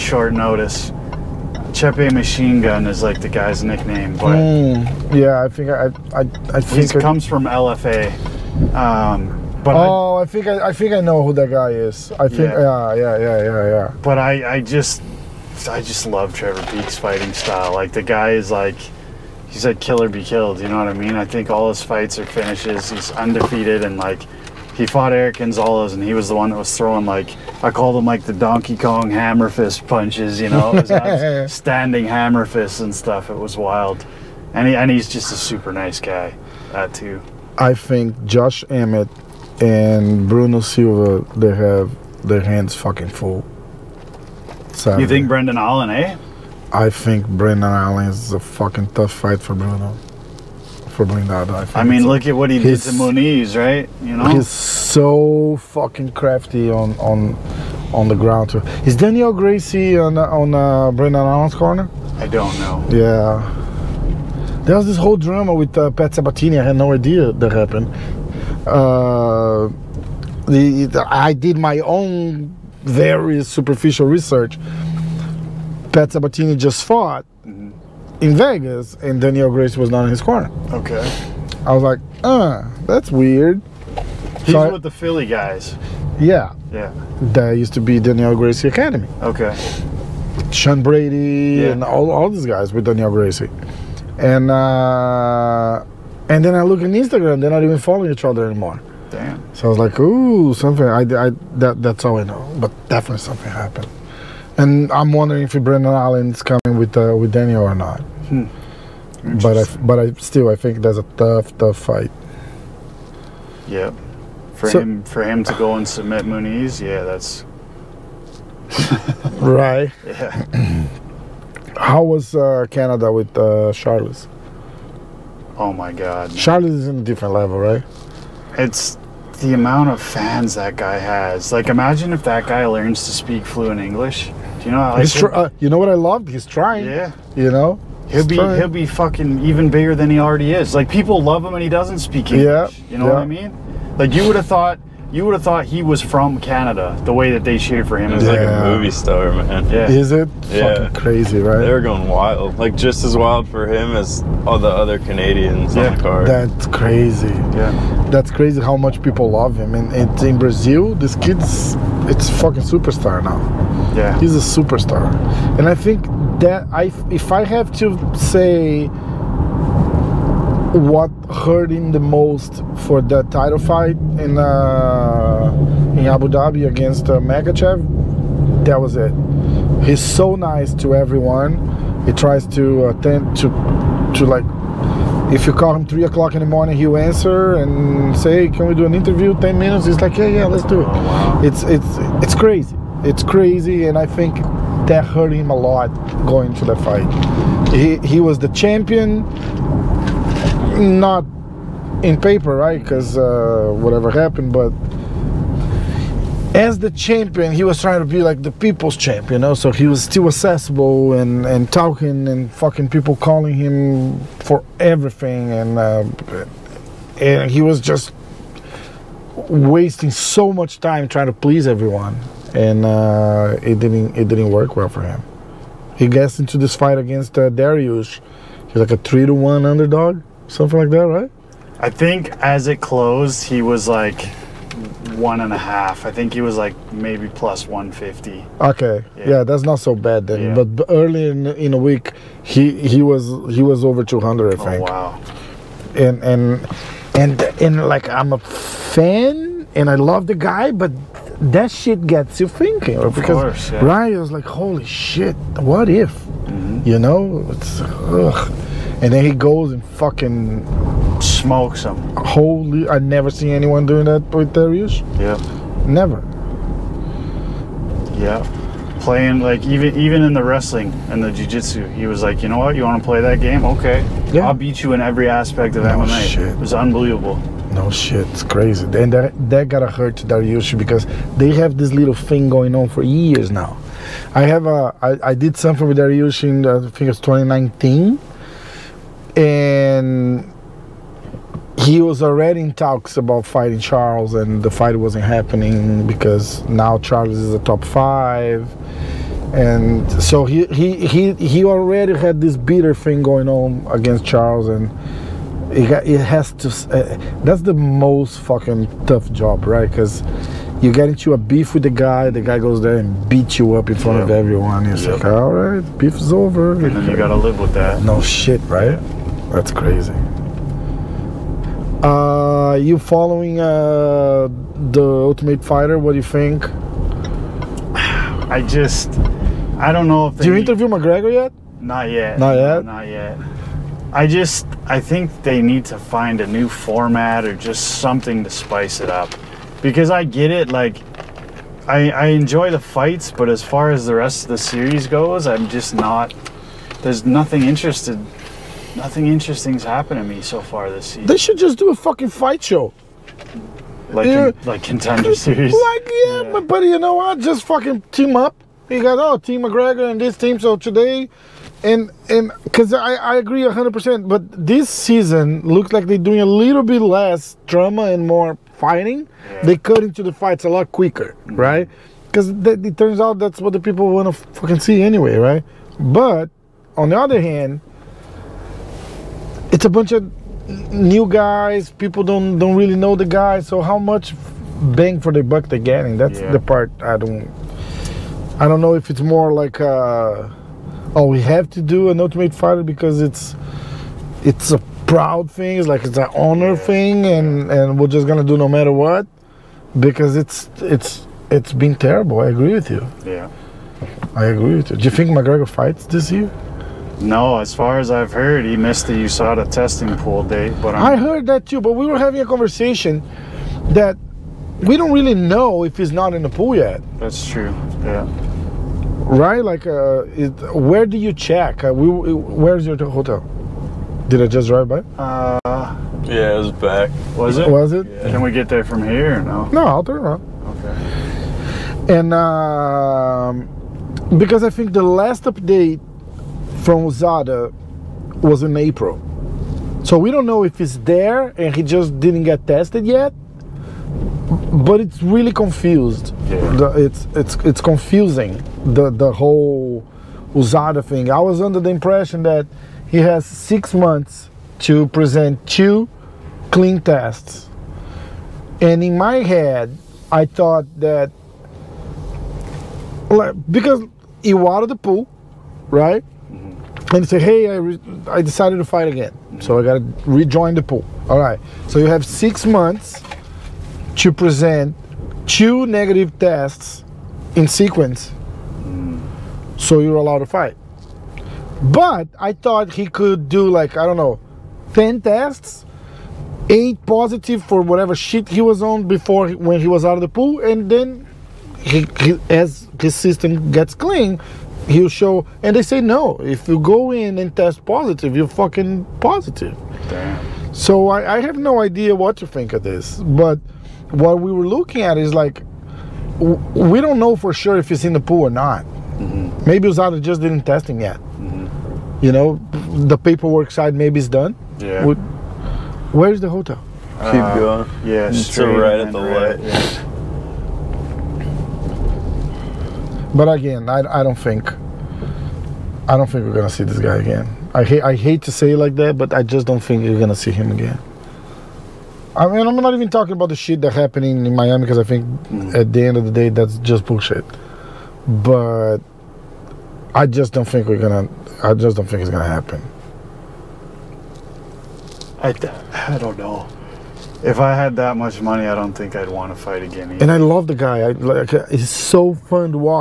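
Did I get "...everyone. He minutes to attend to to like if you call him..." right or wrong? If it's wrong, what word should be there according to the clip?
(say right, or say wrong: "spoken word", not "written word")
wrong: "tries", not "minutes".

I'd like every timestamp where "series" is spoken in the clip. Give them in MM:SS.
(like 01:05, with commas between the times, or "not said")
05:44, 05:55.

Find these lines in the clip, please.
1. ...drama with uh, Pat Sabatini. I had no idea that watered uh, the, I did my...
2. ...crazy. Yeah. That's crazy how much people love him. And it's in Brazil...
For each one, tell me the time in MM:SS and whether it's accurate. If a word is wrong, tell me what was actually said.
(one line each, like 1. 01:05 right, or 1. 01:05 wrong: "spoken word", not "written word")
1. 01:05 wrong: "happened", not "watered"
2. 02:36 right.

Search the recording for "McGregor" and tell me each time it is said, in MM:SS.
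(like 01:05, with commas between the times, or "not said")
05:30, 05:59, 06:45.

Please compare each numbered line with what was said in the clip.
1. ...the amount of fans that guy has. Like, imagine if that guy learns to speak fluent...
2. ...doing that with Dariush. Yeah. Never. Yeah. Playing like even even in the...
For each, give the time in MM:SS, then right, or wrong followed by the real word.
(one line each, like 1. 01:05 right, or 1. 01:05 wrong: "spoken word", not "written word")
1. 02:09 right
2. 04:23 right.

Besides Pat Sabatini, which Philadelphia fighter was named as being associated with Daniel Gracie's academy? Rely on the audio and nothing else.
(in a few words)
Sean Brady.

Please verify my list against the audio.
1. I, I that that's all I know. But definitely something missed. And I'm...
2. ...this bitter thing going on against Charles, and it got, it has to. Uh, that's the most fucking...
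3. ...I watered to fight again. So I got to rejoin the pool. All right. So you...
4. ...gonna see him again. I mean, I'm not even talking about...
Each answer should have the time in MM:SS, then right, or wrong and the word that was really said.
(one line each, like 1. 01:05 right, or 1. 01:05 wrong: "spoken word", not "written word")
1. 01:40 wrong: "happened", not "missed"
2. 05:02 right
3. 07:48 wrong: "decided", not "watered"
4. 08:50 right.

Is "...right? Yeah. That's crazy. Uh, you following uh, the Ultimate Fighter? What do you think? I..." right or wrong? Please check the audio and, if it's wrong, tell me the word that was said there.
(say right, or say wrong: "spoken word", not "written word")
right.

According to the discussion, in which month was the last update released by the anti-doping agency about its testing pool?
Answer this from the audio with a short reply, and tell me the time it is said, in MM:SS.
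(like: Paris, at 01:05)
April, at 07:18.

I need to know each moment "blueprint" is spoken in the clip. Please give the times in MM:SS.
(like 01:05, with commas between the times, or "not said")
not said.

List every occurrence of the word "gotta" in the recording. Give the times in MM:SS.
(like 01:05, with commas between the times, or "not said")
04:39, 05:17.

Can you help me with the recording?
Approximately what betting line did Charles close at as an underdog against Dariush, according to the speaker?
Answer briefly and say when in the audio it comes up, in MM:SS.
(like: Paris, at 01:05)
+150, at 03:57.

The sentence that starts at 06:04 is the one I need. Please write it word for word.
But this season looks like they're doing a little bit less drama and more fighting.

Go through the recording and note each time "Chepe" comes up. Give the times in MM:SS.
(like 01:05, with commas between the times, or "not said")
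00:01.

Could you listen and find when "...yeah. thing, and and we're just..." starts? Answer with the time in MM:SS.
06:36.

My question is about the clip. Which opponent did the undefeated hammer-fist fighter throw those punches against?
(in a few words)
Eric Gonzalez.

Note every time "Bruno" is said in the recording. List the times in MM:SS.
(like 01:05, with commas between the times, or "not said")
00:40, 00:49.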